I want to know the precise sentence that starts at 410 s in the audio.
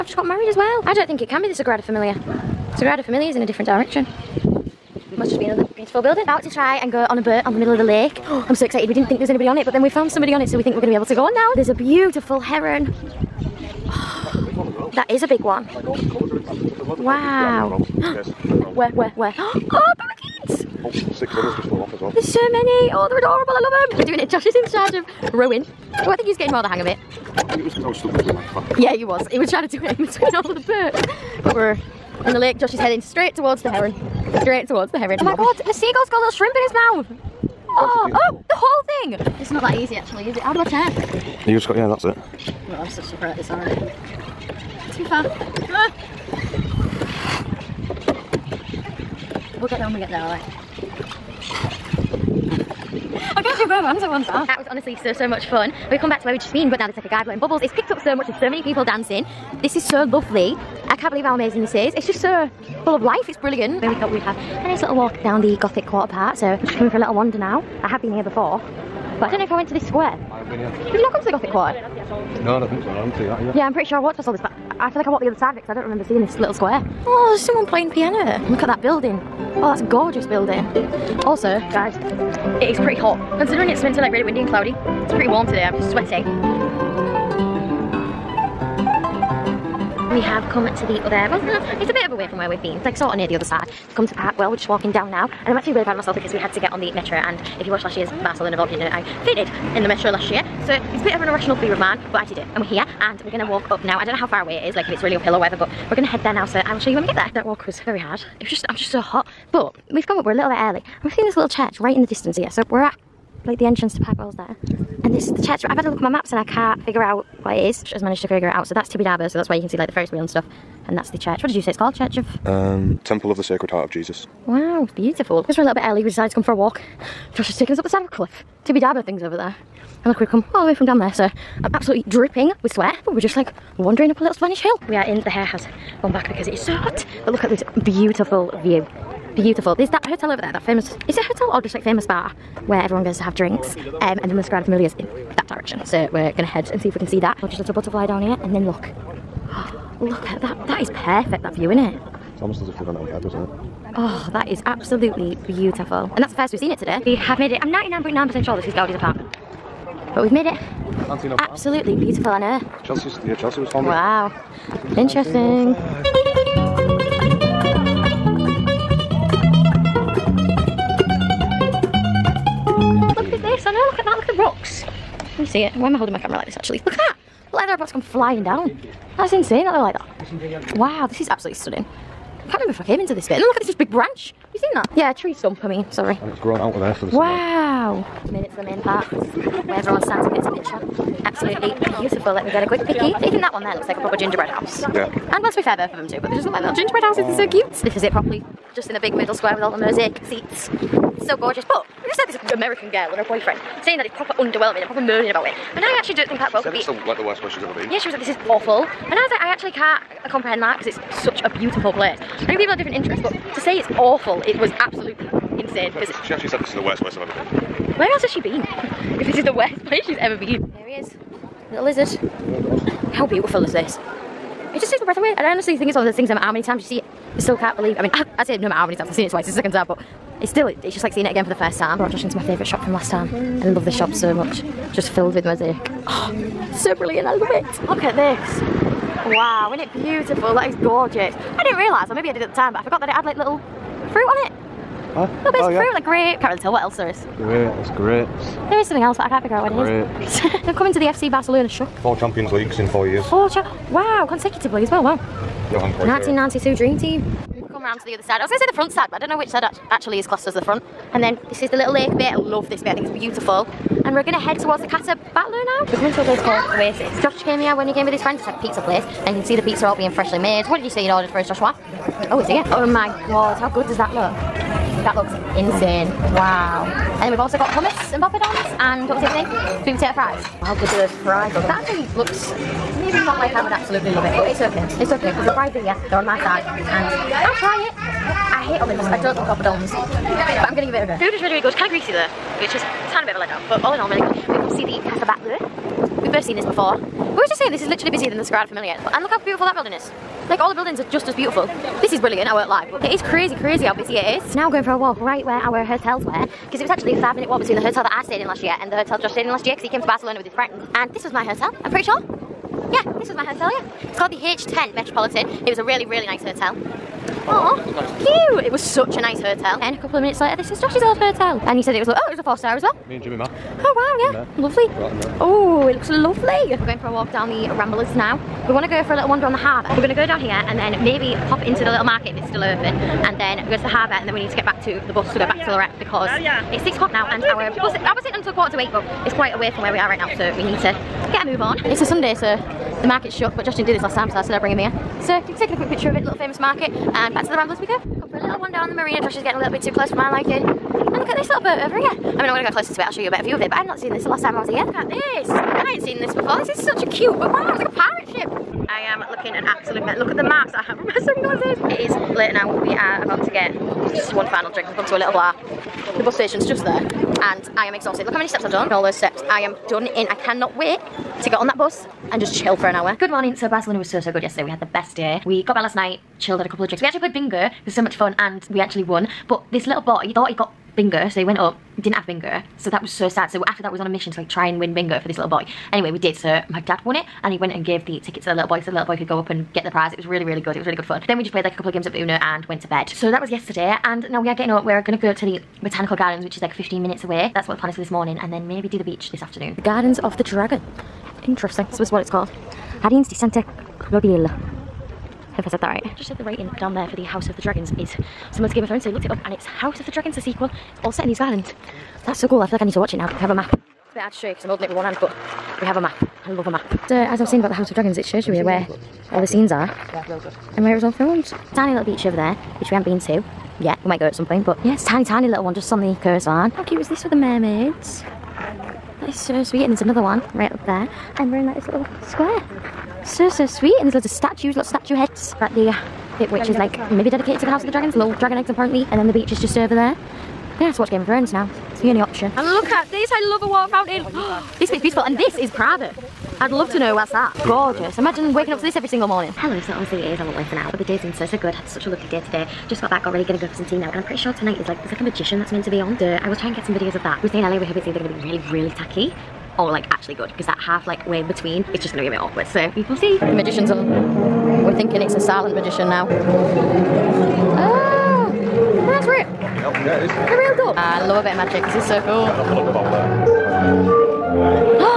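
It's all set in these islands.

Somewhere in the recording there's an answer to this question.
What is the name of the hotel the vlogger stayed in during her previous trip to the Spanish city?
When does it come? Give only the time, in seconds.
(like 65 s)
314 s.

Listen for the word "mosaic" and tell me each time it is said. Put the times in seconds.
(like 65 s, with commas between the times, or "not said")
199 s, 235 s.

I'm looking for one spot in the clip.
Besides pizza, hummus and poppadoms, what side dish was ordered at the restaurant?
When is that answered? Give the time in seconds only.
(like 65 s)
279 s.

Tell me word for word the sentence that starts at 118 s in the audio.
So that's Tibidabo, so that's why you can see like the Ferris wheel and stuff.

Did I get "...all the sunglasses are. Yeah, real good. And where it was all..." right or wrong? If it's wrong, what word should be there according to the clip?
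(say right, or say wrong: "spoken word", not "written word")
wrong: "scenes", not "sunglasses".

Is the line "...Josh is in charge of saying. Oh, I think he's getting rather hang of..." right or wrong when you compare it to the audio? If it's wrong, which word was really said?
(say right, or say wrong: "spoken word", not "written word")
wrong: "rowing", not "saying".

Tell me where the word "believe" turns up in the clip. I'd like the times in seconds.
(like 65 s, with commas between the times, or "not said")
61 s, 227 s.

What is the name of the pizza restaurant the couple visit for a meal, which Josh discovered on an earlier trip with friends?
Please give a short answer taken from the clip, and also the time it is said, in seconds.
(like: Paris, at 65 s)
Oasis, at 266 s.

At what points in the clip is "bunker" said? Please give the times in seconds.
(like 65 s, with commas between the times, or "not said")
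not said.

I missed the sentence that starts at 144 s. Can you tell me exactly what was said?
Um, and then the Sagrada Familia's in that direction.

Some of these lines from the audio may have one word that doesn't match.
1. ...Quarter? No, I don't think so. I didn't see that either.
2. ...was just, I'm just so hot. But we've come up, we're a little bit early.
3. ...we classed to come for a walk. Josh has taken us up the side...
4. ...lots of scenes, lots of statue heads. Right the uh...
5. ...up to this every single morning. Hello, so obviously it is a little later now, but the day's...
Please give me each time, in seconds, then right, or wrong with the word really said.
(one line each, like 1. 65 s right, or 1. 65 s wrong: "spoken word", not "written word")
1. 71 s right
2. 108 s right
3. 126 s wrong: "decided", not "classed"
4. 434 s wrong: "statues", not "scenes"
5. 448 s right.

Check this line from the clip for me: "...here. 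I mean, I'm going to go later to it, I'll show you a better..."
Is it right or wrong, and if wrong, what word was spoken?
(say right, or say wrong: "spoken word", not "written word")
wrong: "closer", not "later".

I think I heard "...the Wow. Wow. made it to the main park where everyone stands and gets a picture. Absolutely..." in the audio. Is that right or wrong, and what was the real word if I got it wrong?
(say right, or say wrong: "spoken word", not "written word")
right.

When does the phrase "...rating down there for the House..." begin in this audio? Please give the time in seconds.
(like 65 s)
406 s.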